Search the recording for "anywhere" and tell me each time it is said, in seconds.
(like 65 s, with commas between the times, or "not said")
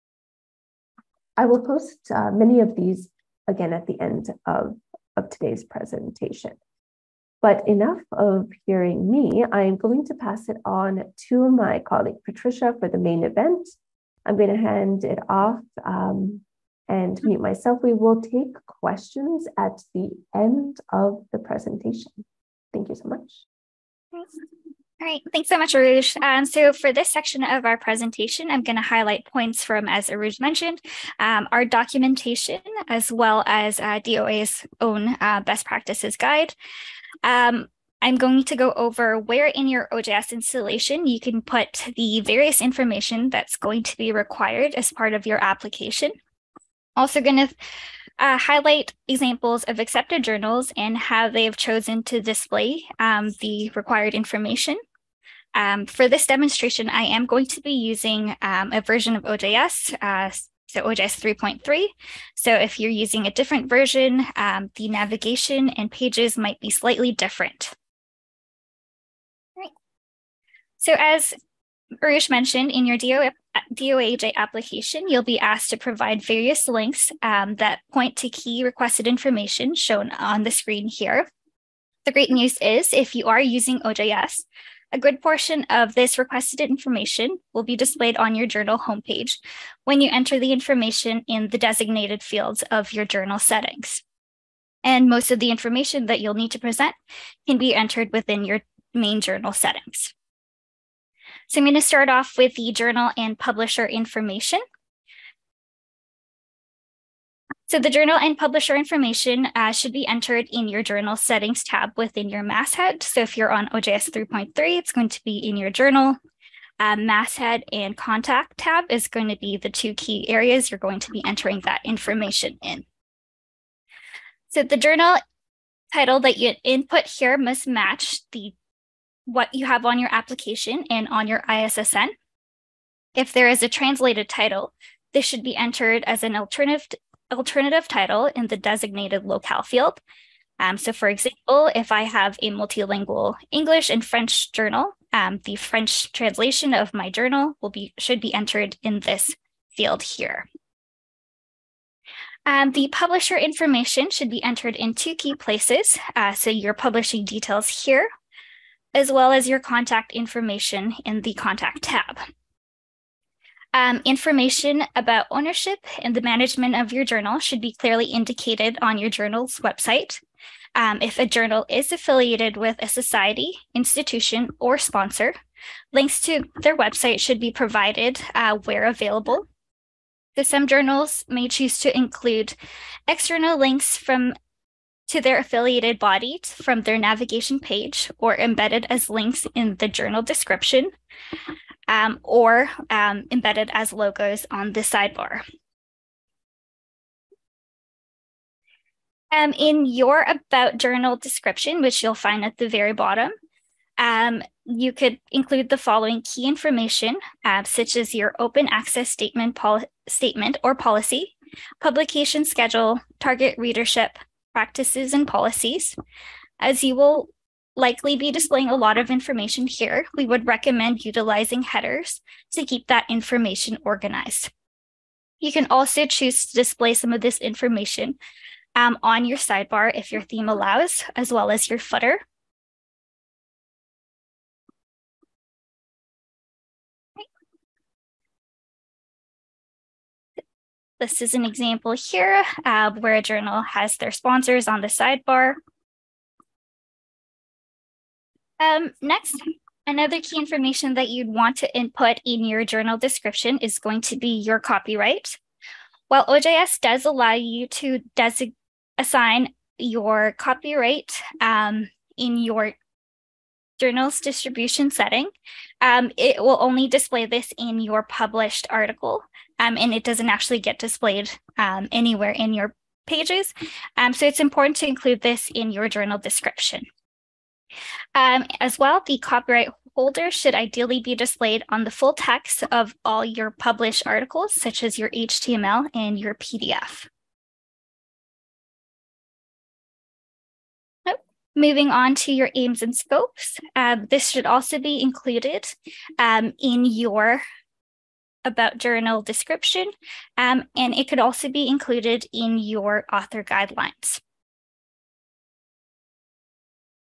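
271 s.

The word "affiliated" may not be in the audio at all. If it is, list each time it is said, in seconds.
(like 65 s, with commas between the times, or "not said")
171 s, 185 s.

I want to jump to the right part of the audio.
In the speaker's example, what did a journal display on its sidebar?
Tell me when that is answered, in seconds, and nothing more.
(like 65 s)
244 s.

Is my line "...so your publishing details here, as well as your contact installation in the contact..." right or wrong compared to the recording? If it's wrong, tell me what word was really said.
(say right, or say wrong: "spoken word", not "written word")
wrong: "information", not "installation".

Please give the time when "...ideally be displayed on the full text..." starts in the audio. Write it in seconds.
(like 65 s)
280 s.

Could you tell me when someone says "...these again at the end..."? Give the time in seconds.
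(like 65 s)
2 s.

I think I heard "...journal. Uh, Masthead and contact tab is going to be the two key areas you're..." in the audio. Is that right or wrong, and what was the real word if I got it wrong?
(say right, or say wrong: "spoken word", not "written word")
right.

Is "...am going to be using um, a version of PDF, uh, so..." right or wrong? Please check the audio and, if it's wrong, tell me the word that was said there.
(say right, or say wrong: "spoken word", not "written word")
wrong: "OJS", not "PDF".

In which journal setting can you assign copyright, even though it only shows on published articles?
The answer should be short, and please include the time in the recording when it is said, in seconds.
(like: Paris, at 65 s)
distribution setting, at 264 s.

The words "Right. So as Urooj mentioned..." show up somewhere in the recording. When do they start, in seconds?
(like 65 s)
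69 s.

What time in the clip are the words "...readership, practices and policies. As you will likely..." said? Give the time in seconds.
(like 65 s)
213 s.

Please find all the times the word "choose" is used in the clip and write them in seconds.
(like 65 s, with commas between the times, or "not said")
181 s, 226 s.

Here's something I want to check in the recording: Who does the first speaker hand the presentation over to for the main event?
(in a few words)
Patricia.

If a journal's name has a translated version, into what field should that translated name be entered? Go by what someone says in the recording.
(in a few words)
alternative title.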